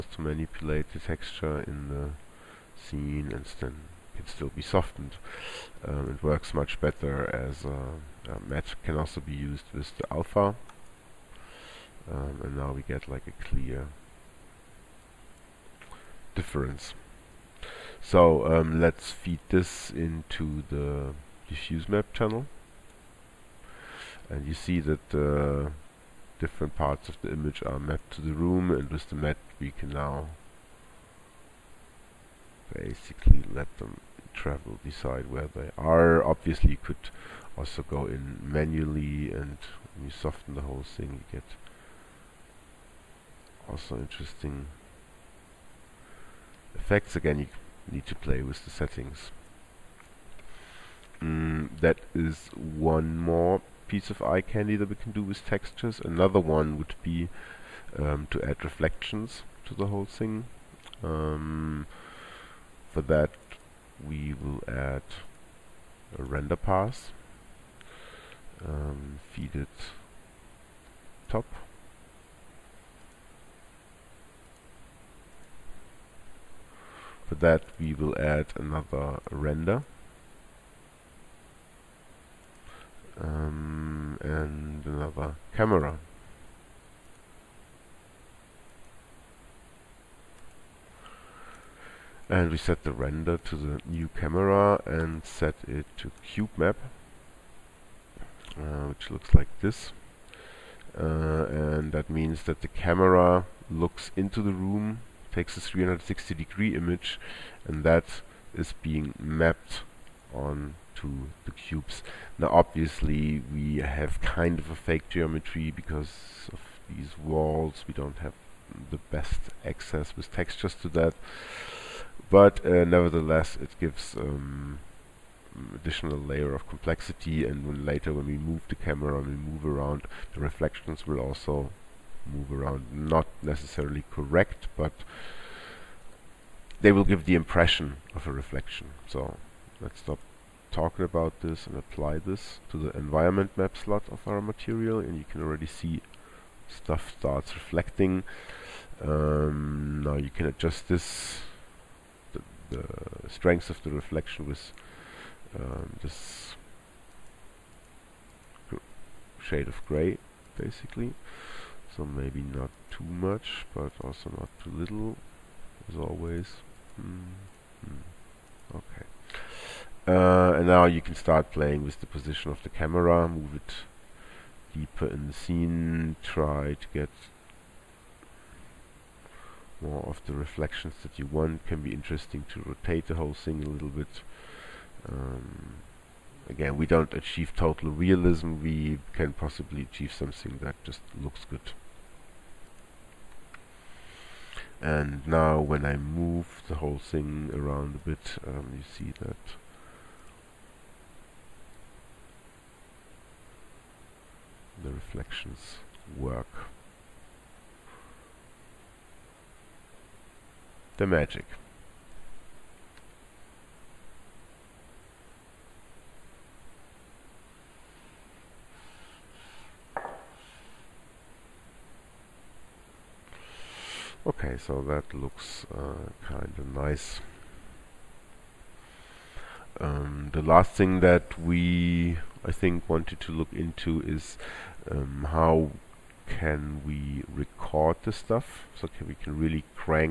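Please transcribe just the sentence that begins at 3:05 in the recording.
Um, again, we don't achieve total realism, we can possibly achieve something that just looks good.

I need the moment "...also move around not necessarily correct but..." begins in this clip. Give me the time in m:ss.
2:11.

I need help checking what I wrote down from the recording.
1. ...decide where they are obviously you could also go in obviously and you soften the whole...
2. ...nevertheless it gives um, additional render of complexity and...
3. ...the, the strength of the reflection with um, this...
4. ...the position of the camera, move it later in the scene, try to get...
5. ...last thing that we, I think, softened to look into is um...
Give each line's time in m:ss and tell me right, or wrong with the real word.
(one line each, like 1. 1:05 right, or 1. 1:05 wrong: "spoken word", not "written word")
1. 0:34 wrong: "manually", not "obviously"
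2. 2:02 wrong: "layer", not "render"
3. 2:32 right
4. 2:51 wrong: "deeper", not "later"
5. 3:50 wrong: "wanted", not "softened".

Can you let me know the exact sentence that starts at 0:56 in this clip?
Another one would be um, to add reflections to the whole thing.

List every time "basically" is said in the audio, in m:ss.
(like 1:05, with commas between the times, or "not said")
0:32, 2:40.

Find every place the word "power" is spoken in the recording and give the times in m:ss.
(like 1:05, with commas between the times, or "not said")
not said.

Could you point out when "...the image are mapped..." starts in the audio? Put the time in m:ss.
0:27.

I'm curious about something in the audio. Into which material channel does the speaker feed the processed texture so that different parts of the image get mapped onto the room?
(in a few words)
diffuse map.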